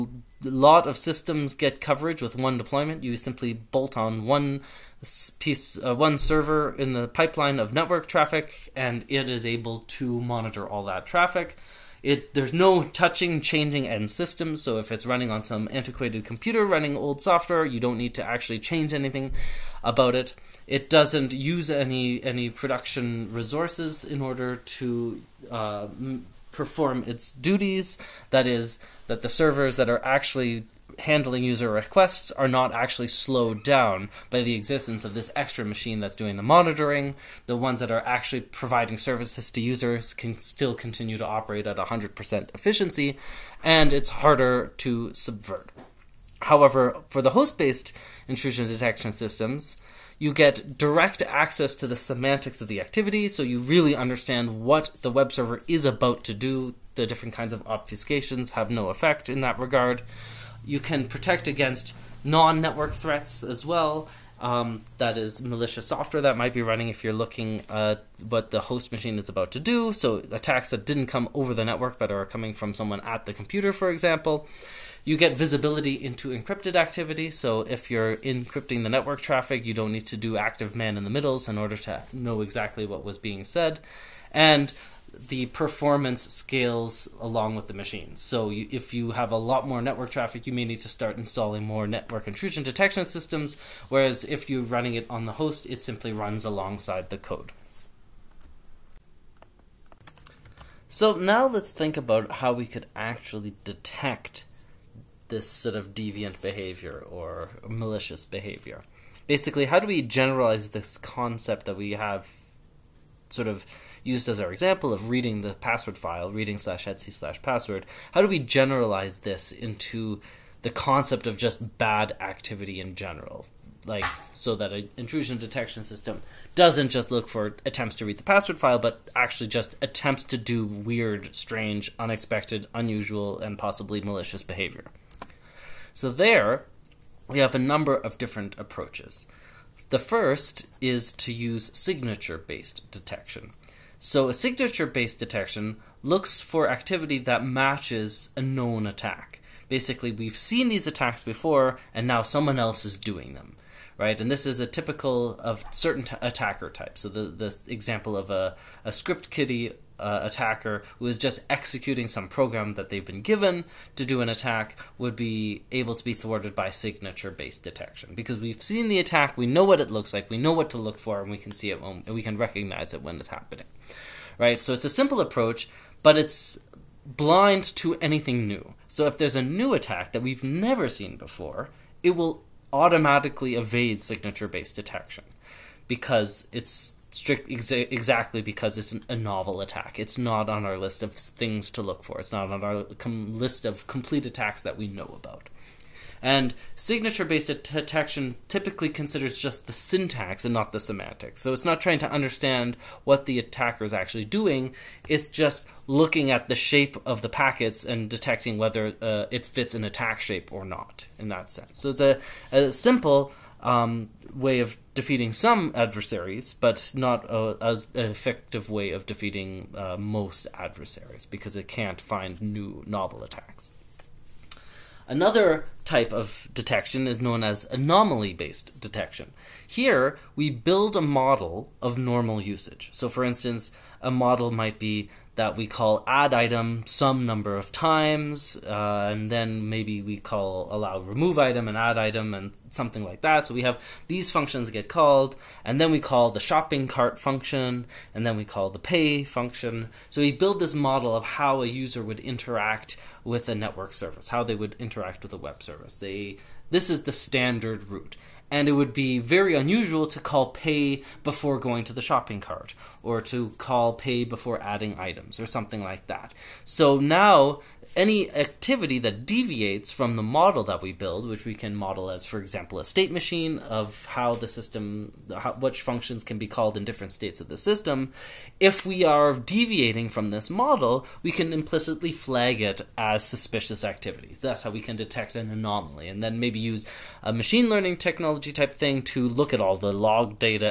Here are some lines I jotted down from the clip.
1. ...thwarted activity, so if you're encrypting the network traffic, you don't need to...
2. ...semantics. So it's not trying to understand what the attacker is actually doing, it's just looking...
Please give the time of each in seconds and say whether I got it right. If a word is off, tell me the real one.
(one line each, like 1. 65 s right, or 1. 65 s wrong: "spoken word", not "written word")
1. 76 s wrong: "encrypted", not "thwarted"
2. 200 s right.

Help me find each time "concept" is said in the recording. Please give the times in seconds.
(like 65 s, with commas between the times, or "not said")
110 s, 120 s.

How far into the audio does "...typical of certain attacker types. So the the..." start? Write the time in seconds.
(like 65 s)
154 s.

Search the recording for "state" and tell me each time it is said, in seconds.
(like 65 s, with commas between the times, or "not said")
272 s, 277 s.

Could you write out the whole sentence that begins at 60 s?
You can protect against non network threats as well.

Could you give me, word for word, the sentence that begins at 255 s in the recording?
They this is the standard route.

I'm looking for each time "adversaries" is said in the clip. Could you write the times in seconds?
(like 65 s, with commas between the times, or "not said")
215 s, 220 s.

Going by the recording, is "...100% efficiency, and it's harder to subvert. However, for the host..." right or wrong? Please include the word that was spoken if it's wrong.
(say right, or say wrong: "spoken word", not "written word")
right.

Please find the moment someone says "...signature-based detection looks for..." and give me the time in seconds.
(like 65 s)
144 s.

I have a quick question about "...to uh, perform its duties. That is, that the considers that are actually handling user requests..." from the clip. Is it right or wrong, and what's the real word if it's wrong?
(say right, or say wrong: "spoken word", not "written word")
wrong: "servers", not "considers".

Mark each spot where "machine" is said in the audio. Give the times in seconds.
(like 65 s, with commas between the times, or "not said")
35 s, 68 s, 87 s, 273 s, 287 s.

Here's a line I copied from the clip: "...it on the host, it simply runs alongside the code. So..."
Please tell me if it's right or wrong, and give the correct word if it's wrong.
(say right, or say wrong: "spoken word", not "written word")
right.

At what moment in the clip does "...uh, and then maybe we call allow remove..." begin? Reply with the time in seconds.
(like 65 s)
238 s.